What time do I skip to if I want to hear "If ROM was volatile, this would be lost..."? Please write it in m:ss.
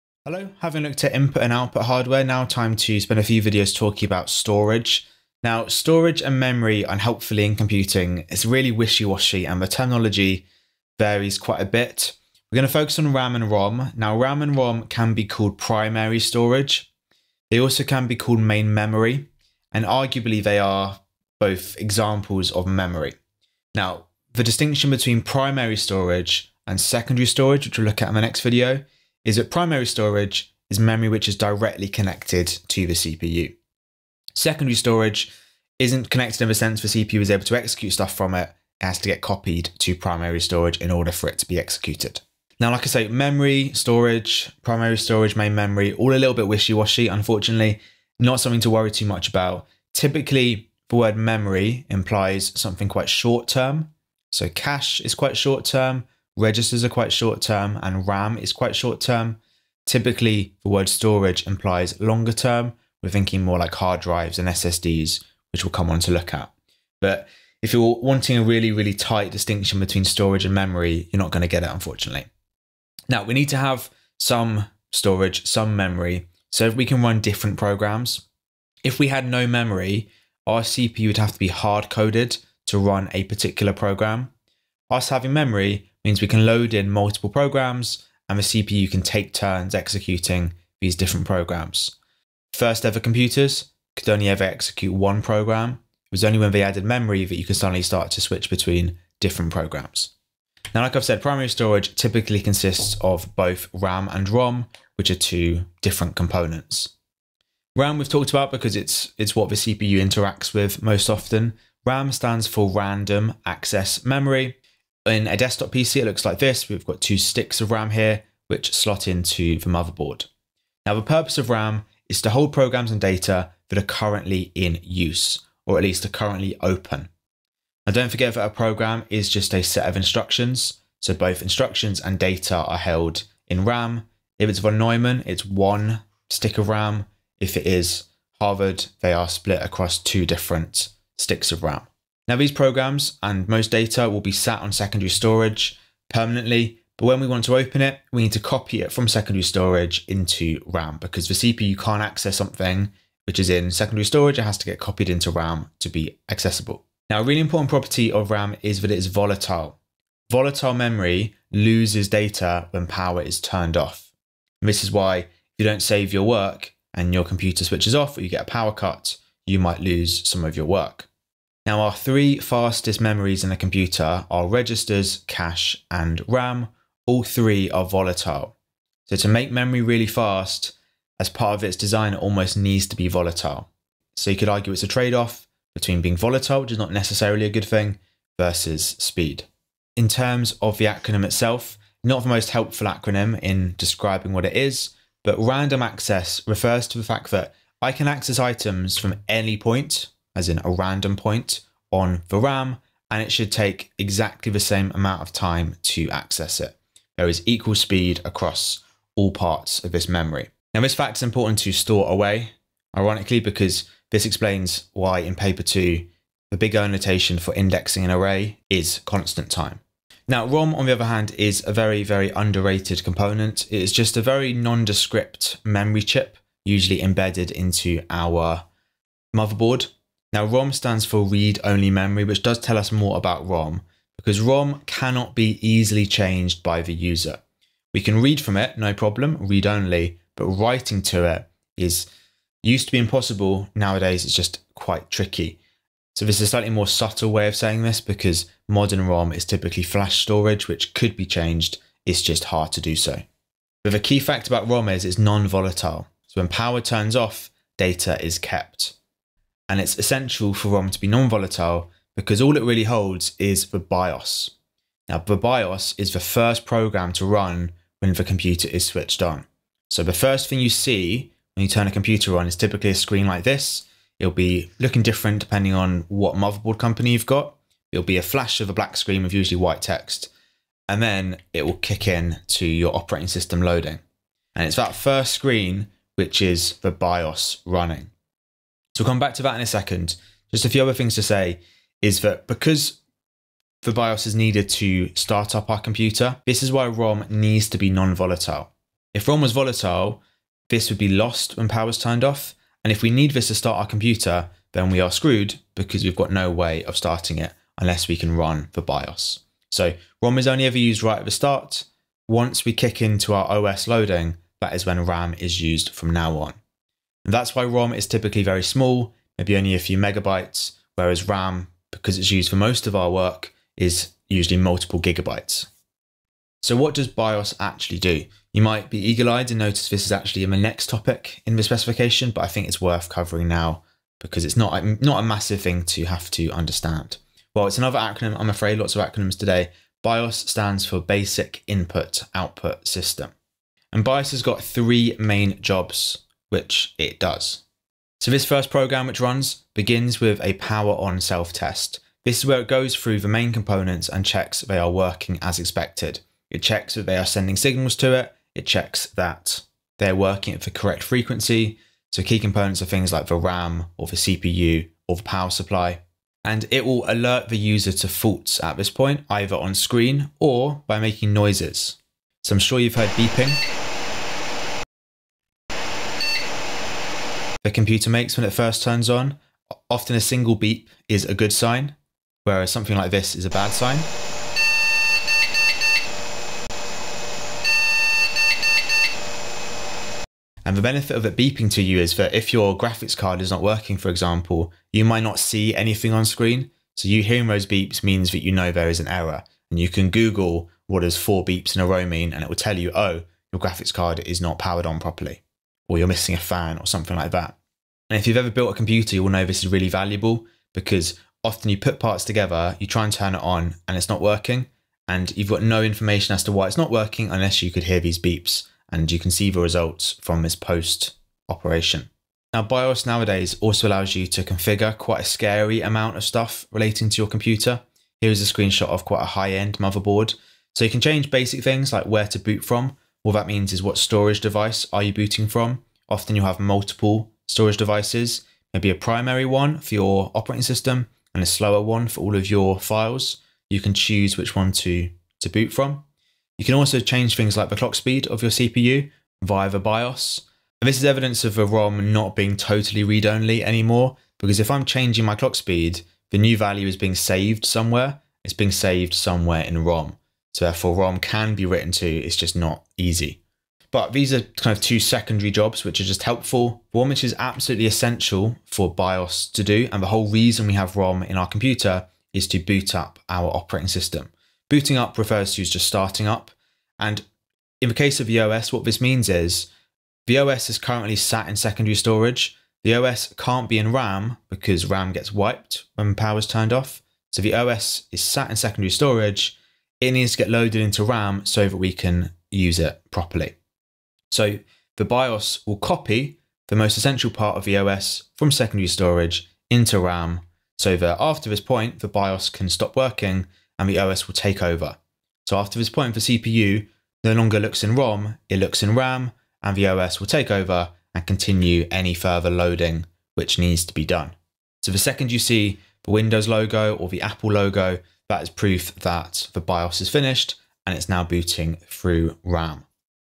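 4:59.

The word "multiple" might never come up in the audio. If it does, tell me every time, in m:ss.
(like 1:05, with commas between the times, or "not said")
1:26, 5:24, 7:16.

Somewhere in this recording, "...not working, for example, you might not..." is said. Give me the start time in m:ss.
6:33.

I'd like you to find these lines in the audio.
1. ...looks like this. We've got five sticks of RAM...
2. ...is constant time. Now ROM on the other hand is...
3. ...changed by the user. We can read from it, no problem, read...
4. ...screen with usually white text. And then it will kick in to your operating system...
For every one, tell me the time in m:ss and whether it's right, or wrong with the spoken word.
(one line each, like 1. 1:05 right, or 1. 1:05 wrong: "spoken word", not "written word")
1. 1:56 wrong: "two", not "five"
2. 3:38 right
3. 3:56 right
4. 4:38 right.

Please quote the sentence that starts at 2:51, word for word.
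Now, our three fastest memories in a computer are registers, cache, and RAM.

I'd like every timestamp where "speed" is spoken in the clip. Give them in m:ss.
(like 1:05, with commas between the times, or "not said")
3:08, 3:27, 7:27, 7:35.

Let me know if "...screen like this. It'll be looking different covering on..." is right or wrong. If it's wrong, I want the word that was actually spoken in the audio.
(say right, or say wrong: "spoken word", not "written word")
wrong: "depending", not "covering".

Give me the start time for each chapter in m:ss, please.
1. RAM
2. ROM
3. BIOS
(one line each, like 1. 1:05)
1. 1:48
2. 3:41
3. 5:27.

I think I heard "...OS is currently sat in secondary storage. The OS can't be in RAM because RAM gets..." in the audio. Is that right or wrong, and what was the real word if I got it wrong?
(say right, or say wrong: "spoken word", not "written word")
right.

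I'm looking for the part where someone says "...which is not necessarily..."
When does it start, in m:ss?
3:06.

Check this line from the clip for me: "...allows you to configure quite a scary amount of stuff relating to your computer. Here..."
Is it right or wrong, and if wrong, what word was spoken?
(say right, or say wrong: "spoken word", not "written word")
right.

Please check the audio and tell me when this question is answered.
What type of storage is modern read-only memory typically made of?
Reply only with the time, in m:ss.
4:09.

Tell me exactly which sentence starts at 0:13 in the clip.
Now, RAM and ROM can be called primary storage.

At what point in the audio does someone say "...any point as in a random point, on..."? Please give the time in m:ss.
3:19.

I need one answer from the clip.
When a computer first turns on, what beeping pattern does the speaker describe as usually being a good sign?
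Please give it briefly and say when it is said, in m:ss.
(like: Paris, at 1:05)
A single beep, at 6:20.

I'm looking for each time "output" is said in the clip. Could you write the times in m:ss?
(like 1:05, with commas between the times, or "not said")
0:01, 5:42.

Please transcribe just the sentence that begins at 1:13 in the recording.
Now, we need to have some storage, some memory, so we can run different programs.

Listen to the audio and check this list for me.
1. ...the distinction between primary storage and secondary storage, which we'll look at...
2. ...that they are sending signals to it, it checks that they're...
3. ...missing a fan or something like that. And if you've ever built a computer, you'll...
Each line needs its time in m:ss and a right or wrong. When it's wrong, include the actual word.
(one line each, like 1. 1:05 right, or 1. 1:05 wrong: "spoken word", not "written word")
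1. 0:24 right
2. 5:56 right
3. 6:46 right.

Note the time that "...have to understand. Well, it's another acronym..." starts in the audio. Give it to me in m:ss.
5:36.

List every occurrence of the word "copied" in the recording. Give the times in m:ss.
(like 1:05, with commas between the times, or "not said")
0:39, 2:34.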